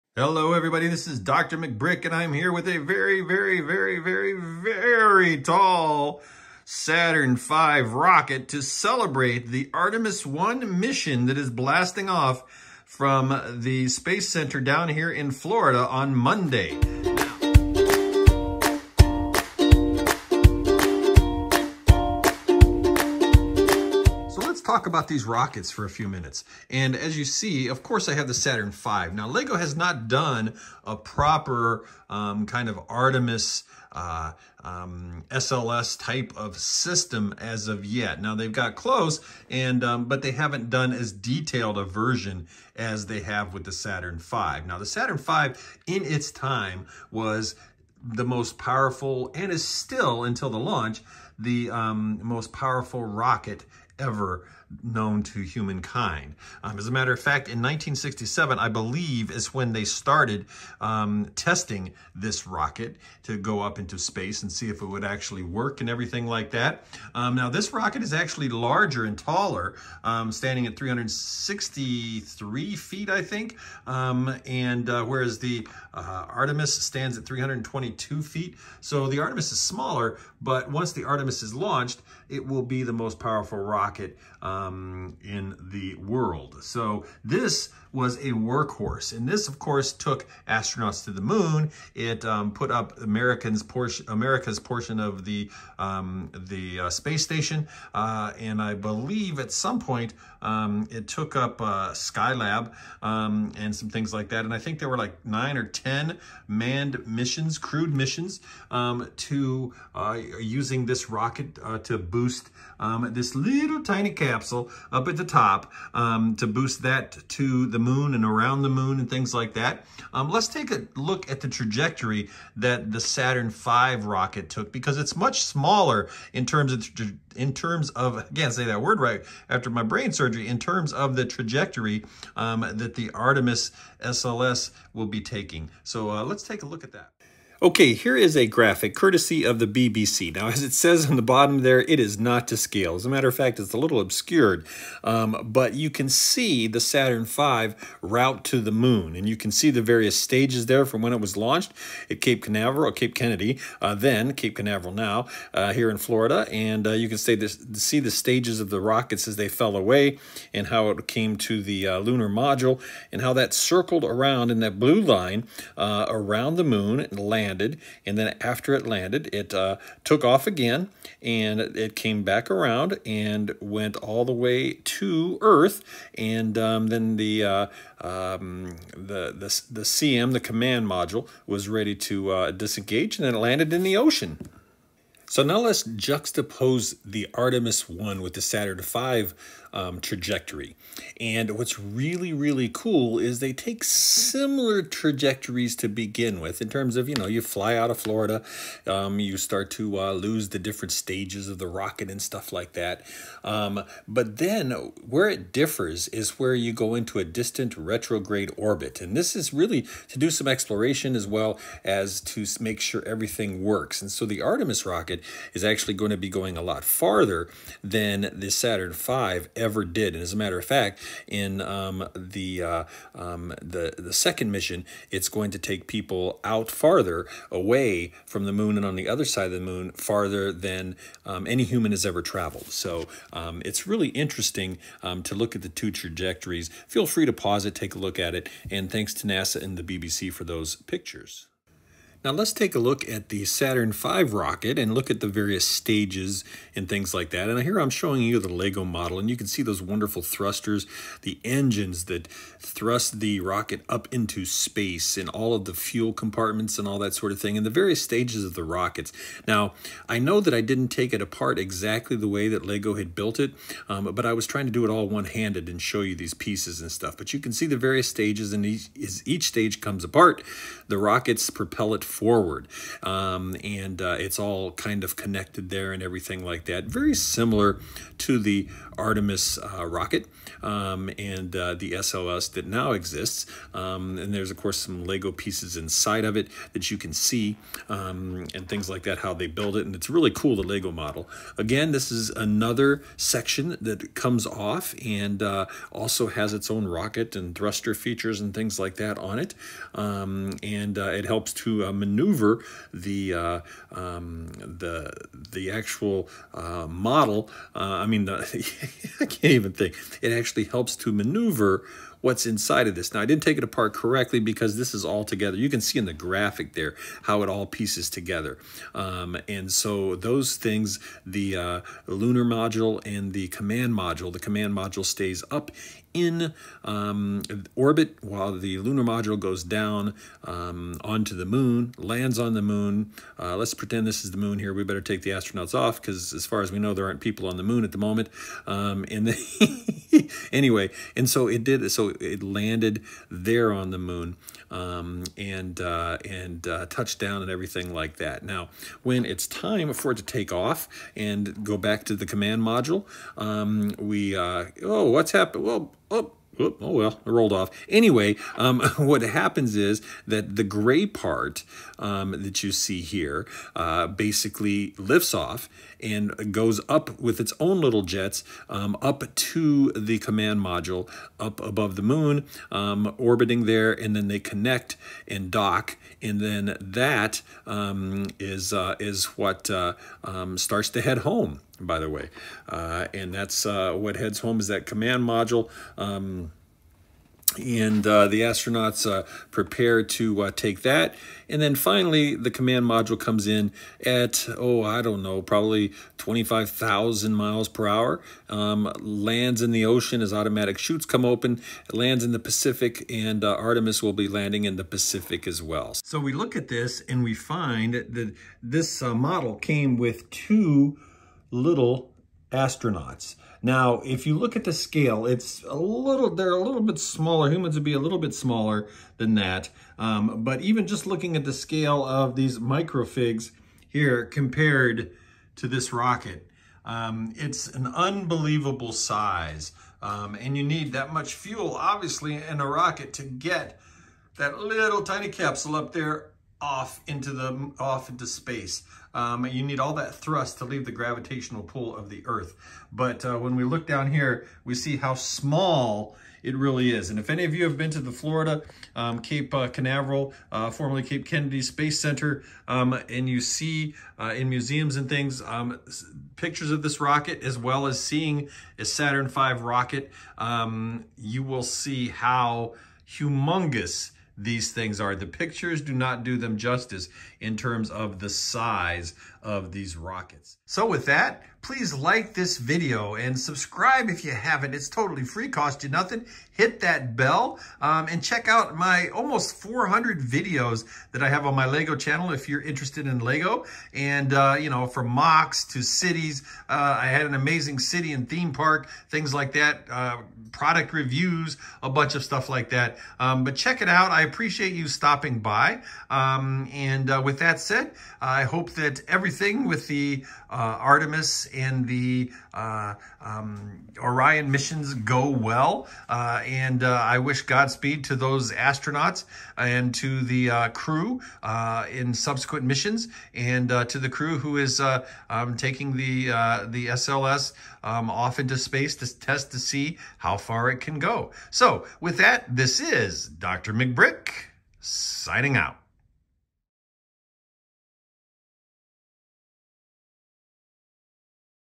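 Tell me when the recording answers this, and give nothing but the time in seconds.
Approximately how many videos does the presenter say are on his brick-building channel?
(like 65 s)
479 s.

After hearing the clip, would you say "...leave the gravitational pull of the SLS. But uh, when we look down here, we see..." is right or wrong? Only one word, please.
wrong.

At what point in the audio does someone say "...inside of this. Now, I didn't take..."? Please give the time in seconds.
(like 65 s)
312 s.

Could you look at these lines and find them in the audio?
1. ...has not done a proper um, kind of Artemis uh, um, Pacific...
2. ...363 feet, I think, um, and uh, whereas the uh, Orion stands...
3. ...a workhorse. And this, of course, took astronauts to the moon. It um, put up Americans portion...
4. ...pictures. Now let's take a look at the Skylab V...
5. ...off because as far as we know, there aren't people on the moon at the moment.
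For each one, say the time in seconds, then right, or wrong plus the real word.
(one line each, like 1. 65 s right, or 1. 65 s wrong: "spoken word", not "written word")
1. 29 s wrong: "SLS", not "Pacific"
2. 70 s wrong: "Artemis", not "Orion"
3. 88 s right
4. 240 s wrong: "Saturn", not "Skylab"
5. 335 s right.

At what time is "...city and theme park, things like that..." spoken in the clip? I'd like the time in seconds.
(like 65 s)
487 s.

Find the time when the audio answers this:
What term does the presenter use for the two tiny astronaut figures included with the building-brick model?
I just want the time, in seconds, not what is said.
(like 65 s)
422 s.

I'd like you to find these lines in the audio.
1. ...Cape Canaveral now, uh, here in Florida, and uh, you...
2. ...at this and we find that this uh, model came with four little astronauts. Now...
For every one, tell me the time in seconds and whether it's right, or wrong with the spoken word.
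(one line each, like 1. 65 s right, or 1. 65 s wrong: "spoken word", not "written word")
1. 154 s right
2. 406 s wrong: "two", not "four".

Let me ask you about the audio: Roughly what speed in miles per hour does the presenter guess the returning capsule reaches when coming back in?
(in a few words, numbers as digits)
25,000 miles per hour.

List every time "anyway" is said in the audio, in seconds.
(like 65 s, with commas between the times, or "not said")
340 s, 357 s.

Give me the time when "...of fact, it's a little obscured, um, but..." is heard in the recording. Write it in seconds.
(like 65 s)
143 s.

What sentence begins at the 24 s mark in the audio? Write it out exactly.
talk about these rockets for a few minutes.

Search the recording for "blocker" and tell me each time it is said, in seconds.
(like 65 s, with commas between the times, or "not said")
not said.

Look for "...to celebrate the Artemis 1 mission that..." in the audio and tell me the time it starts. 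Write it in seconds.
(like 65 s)
8 s.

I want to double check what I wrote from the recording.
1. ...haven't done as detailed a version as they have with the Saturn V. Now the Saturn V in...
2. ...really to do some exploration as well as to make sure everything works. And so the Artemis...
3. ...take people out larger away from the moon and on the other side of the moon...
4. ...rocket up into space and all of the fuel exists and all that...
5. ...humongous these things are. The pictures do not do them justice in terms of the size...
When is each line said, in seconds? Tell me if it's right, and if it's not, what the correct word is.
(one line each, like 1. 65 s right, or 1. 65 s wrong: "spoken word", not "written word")
1. 40 s right
2. 209 s right
3. 225 s wrong: "farther", not "larger"
4. 253 s wrong: "compartments", not "exists"
5. 463 s right.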